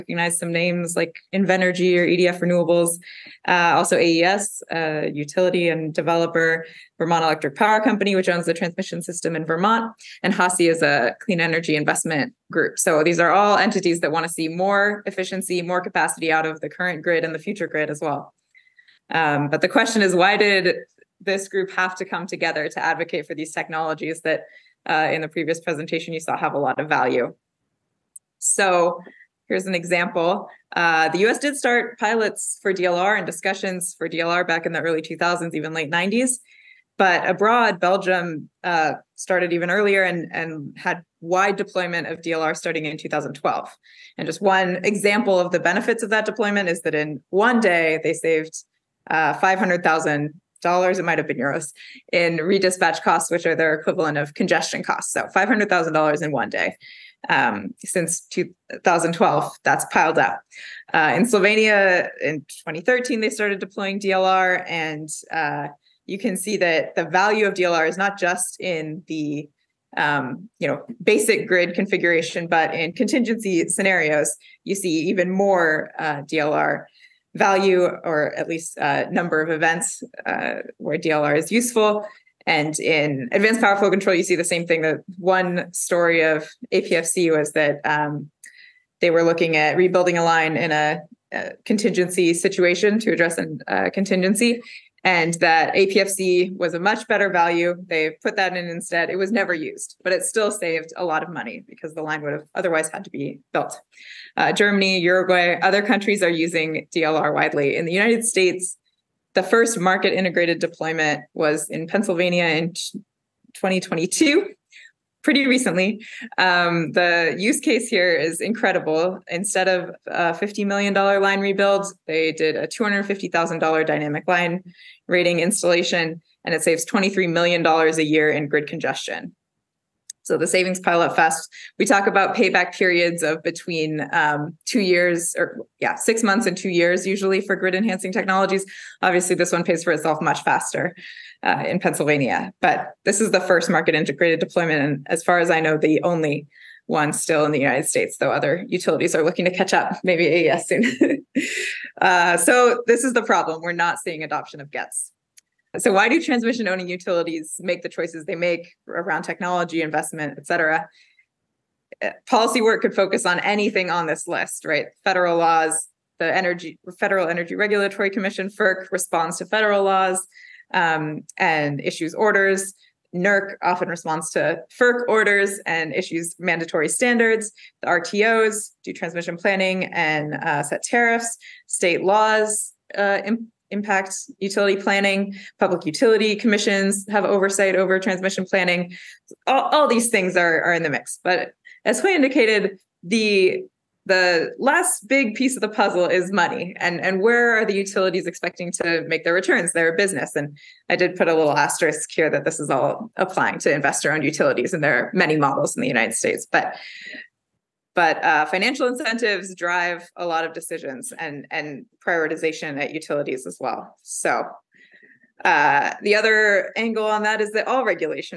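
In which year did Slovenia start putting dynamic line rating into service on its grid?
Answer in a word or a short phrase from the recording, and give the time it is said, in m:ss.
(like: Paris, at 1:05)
2013, at 1:02.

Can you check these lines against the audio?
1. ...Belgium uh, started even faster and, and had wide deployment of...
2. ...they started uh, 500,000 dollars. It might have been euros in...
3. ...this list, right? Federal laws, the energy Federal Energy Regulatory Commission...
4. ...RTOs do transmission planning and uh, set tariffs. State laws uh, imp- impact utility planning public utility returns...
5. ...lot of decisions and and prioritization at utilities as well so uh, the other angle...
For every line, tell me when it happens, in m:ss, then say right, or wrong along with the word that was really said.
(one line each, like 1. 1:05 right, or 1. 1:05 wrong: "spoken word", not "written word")
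1. 0:37 wrong: "earlier", not "faster"
2. 0:48 wrong: "saved", not "started"
3. 2:44 right
4. 2:57 wrong: "commissions", not "returns"
5. 3:30 right.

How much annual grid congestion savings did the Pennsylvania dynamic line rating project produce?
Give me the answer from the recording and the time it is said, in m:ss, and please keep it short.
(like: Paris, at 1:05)
$23 million, at 2:06.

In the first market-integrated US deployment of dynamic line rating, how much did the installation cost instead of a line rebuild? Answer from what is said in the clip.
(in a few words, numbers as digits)
$250,000.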